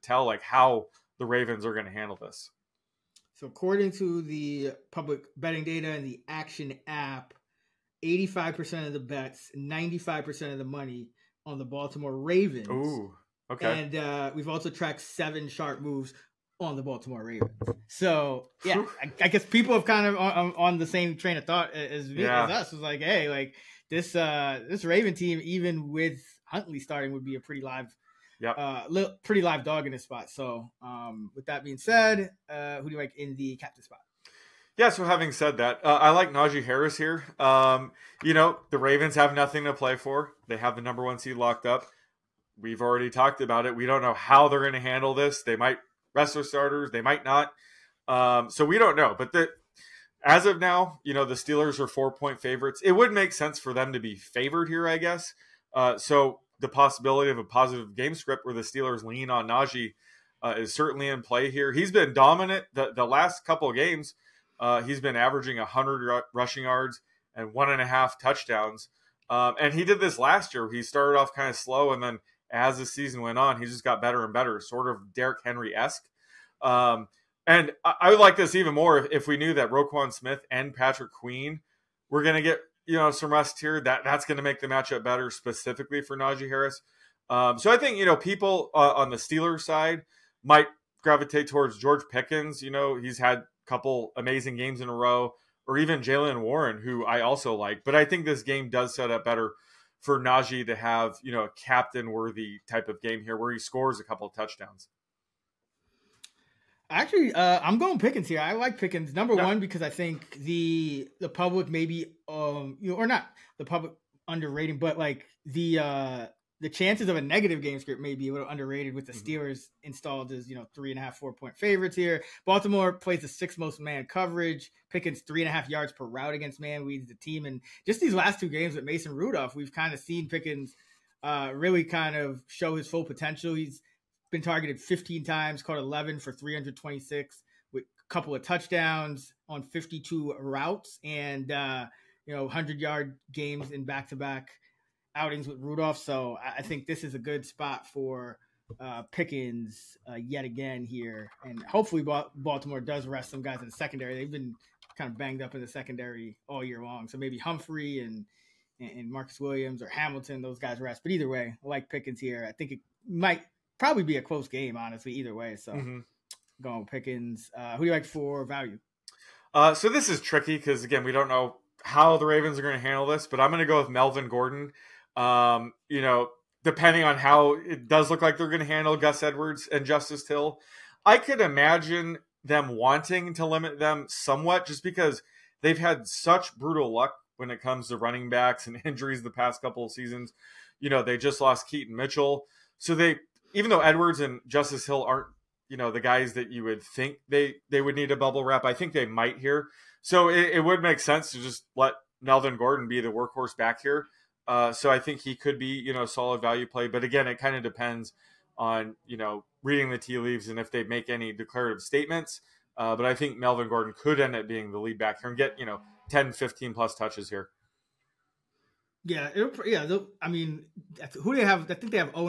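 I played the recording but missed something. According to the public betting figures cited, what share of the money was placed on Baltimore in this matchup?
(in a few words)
95%.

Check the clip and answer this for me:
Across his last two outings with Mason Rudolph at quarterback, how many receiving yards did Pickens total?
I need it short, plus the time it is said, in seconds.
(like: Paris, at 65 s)
326, at 136 s.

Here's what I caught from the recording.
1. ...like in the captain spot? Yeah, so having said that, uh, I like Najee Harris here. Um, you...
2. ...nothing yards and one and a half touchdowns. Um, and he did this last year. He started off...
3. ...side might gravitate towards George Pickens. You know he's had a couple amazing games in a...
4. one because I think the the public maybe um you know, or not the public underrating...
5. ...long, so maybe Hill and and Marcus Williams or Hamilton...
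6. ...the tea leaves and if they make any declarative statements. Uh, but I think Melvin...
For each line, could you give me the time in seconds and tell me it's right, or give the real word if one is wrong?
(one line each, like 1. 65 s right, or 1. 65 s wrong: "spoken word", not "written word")
1. 32 s right
2. 66 s wrong: "rushing", not "nothing"
3. 89 s right
4. 109 s right
5. 156 s wrong: "Humphrey", not "Hill"
6. 209 s right.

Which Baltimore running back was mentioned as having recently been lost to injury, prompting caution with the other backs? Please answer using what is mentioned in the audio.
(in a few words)
Keaton Mitchell.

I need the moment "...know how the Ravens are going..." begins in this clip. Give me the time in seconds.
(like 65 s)
171 s.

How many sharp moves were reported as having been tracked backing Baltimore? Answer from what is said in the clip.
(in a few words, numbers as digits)
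7.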